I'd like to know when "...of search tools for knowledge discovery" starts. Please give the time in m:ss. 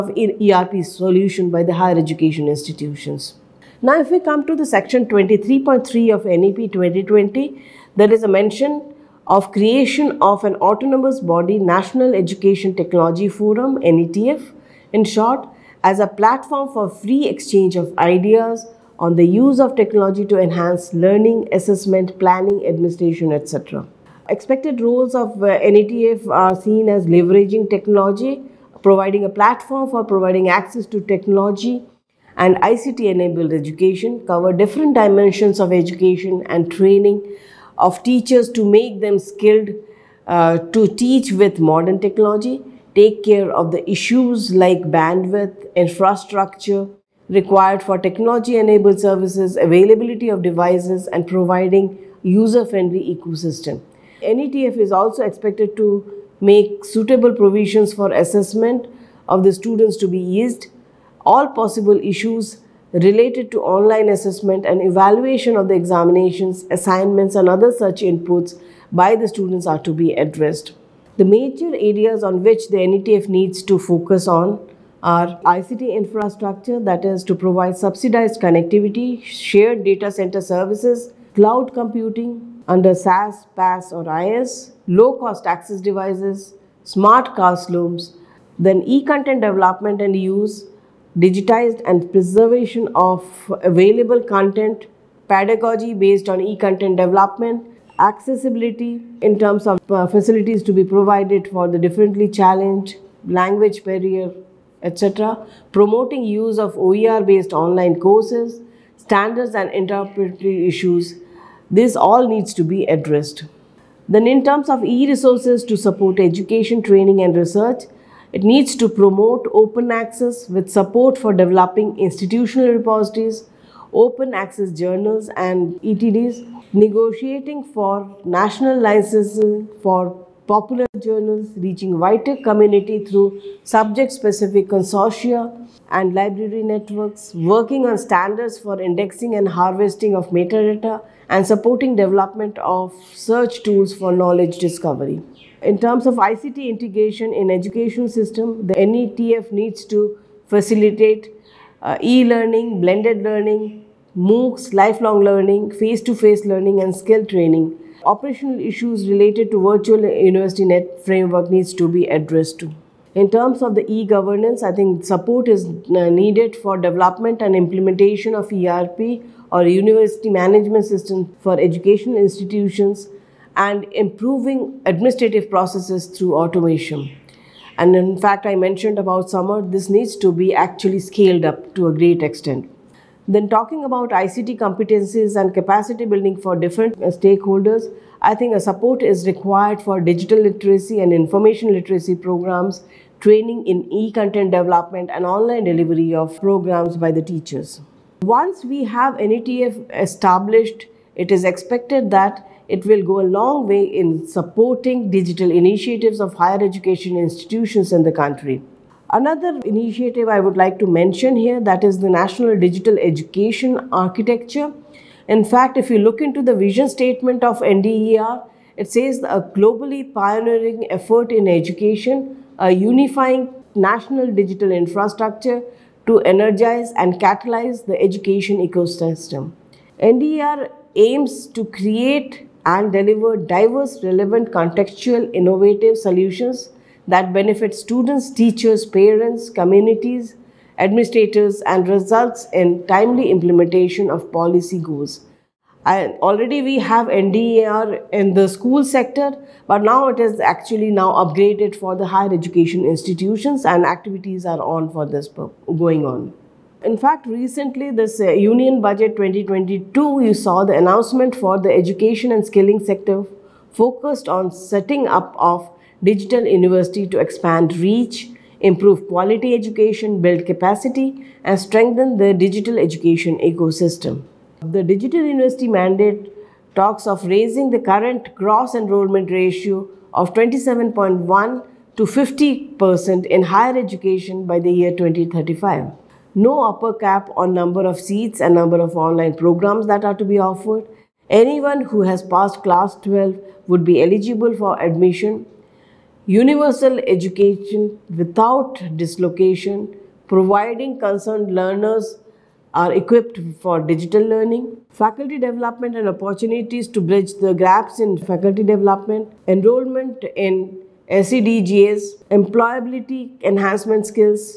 2:22.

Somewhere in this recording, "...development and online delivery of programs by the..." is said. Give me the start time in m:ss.
3:14.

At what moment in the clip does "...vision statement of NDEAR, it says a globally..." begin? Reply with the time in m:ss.
3:36.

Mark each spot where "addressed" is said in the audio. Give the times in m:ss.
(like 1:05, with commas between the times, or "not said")
1:10, 1:52, 2:42.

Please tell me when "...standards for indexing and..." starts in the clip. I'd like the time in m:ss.
2:17.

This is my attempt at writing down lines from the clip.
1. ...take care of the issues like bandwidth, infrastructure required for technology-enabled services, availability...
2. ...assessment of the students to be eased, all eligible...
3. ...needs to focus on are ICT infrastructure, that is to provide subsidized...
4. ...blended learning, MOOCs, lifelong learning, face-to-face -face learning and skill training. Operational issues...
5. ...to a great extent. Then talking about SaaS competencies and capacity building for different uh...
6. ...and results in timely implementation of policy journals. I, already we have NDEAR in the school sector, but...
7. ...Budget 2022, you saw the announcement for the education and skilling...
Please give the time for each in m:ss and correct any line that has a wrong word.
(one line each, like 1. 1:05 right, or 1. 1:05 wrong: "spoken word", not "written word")
1. 0:42 right
2. 0:58 wrong: "possible", not "eligible"
3. 1:13 right
4. 2:32 right
5. 3:01 wrong: "ICT", not "SaaS"
6. 4:01 wrong: "goals", not "journals"
7. 4:18 right.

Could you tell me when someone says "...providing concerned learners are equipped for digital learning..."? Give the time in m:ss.
5:00.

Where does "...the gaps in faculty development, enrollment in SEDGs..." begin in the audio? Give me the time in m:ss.
5:07.